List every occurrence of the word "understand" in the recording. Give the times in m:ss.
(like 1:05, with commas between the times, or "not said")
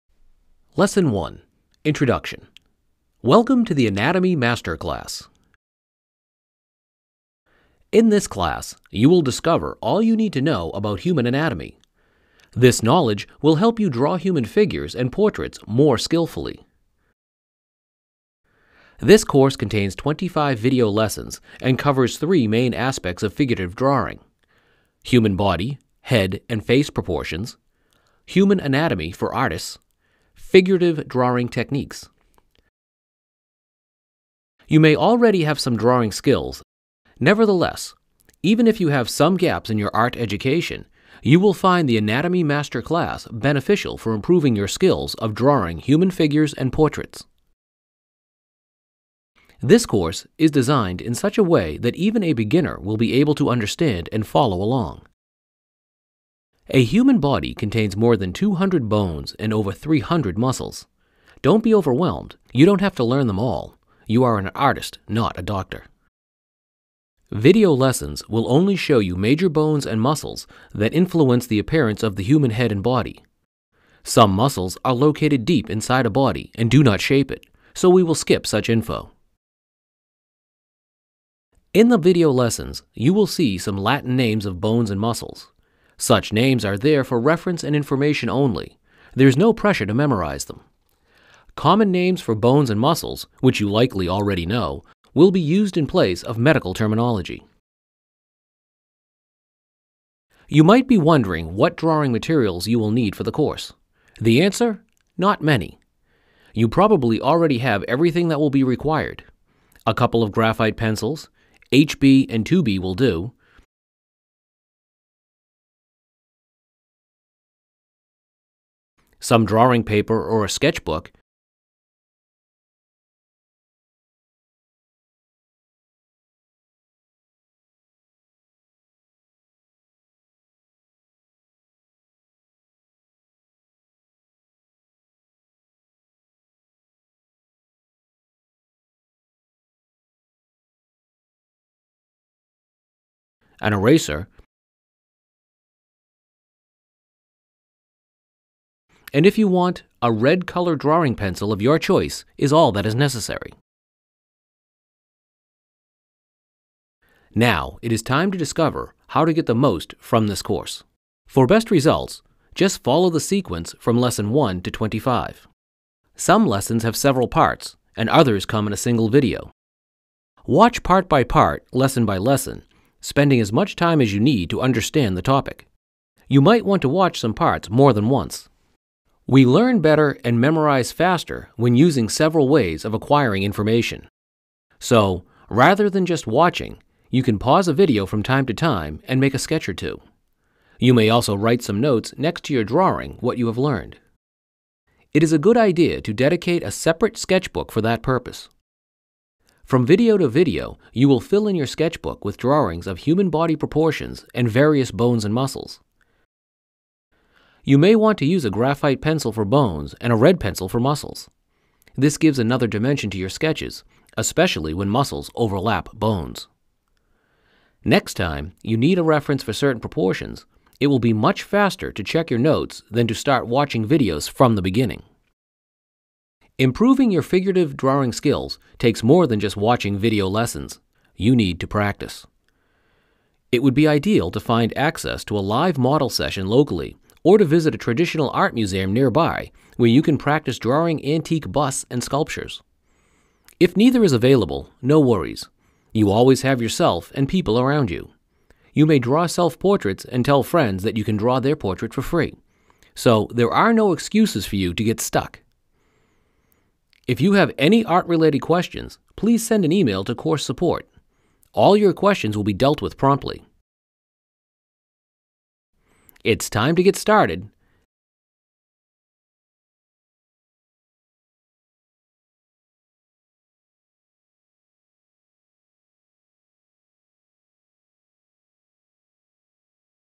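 0:53, 2:54.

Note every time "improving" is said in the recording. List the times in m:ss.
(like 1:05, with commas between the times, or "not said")
0:44, 3:46.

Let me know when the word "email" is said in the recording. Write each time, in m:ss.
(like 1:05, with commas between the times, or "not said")
4:19.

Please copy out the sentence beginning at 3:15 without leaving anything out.
It is a good idea to dedicate a separate sketchbook for that purpose.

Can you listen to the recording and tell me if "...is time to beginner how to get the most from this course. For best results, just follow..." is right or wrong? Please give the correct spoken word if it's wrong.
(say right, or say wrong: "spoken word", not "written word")
wrong: "discover", not "beginner".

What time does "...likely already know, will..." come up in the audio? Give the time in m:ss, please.
1:33.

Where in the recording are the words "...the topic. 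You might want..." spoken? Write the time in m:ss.
2:55.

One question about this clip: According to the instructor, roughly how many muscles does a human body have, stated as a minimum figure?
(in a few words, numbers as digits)
over 300.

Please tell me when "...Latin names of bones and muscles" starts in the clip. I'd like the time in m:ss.
1:23.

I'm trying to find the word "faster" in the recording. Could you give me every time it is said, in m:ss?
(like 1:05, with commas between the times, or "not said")
3:00, 3:41.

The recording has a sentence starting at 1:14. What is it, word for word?
Some muscles are located deep inside a body and do not shape it, so we will skip such info.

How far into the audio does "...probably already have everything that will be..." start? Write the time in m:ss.
1:46.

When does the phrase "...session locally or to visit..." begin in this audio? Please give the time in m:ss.
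3:56.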